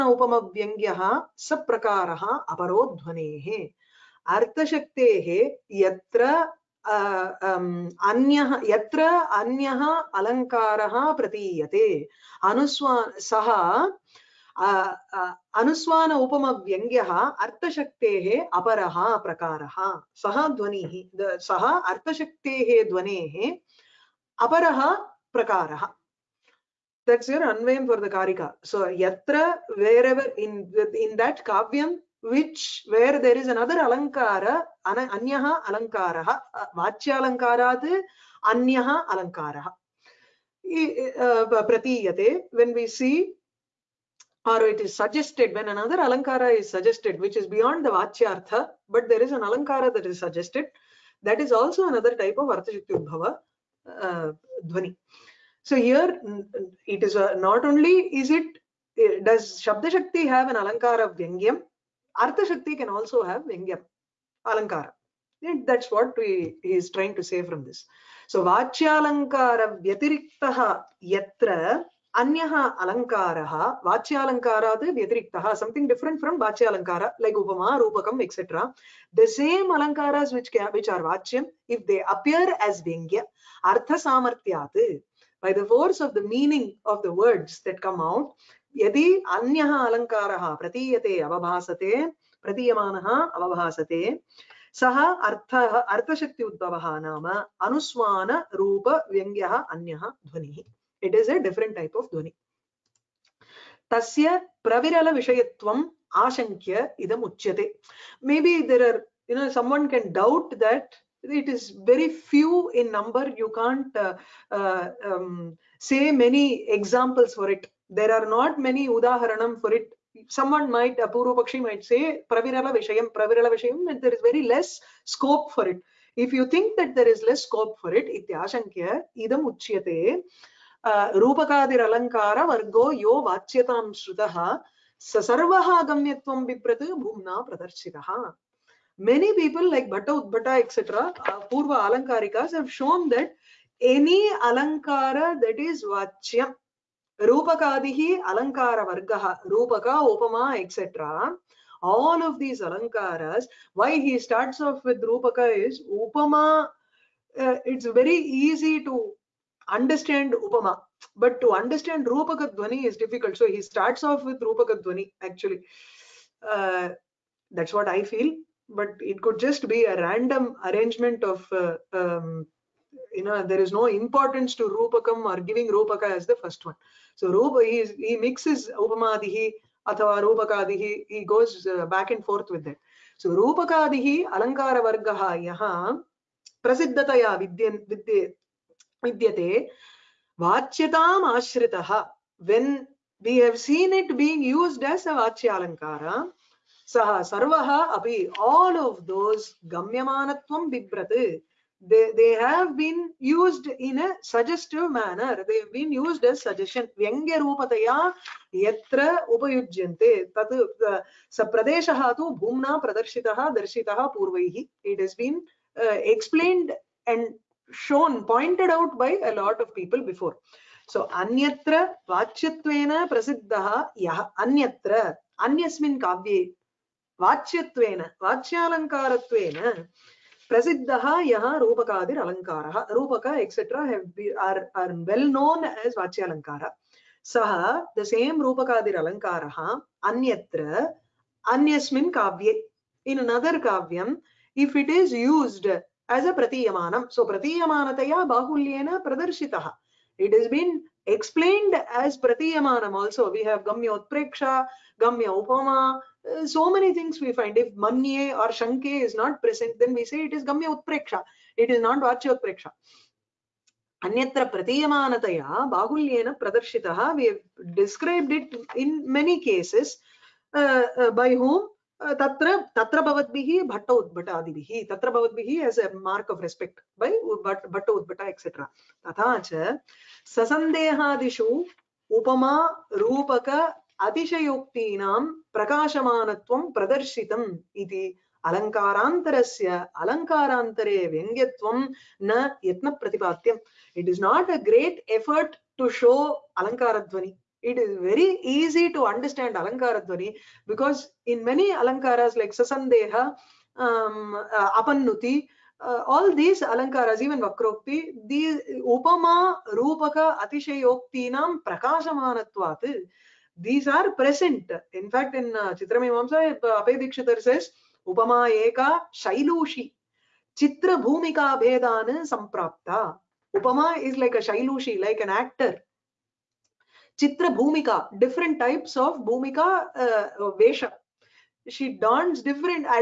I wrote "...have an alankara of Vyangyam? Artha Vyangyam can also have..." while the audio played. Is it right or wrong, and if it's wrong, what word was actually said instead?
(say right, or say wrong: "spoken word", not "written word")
wrong: "Shakti", not "Vyangyam".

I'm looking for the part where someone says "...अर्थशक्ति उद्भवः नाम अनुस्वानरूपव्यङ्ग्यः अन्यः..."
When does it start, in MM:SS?
01:35.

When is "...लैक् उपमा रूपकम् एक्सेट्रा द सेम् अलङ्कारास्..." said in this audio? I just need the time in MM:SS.
01:17.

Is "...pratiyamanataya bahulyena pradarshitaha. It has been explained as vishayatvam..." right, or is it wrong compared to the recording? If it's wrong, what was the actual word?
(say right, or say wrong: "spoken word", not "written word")
wrong: "pratiyamanam", not "vishayatvam".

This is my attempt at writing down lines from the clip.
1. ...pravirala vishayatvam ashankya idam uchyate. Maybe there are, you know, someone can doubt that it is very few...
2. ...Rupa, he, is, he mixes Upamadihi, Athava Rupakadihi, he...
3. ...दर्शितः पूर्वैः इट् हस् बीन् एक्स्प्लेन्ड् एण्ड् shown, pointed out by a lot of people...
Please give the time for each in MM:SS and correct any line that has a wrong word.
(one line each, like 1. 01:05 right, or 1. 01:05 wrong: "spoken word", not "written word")
1. 01:44 right
2. 02:57 right
3. 03:33 right.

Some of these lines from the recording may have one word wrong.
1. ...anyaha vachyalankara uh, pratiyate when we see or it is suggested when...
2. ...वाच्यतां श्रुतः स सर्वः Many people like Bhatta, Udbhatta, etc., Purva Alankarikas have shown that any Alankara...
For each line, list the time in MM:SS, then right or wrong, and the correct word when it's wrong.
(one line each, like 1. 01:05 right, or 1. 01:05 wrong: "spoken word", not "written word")
1. 00:38 wrong: "alankara", not "vachyalankara"
2. 02:13 right.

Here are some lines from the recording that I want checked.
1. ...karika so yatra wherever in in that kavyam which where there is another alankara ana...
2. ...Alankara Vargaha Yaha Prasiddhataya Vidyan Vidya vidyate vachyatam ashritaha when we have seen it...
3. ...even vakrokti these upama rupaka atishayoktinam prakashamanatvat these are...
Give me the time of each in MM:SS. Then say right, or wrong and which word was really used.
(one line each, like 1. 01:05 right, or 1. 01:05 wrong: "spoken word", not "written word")
1. 00:28 right
2. 03:04 right
3. 05:07 right.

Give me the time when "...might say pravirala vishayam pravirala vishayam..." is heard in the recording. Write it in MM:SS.
02:01.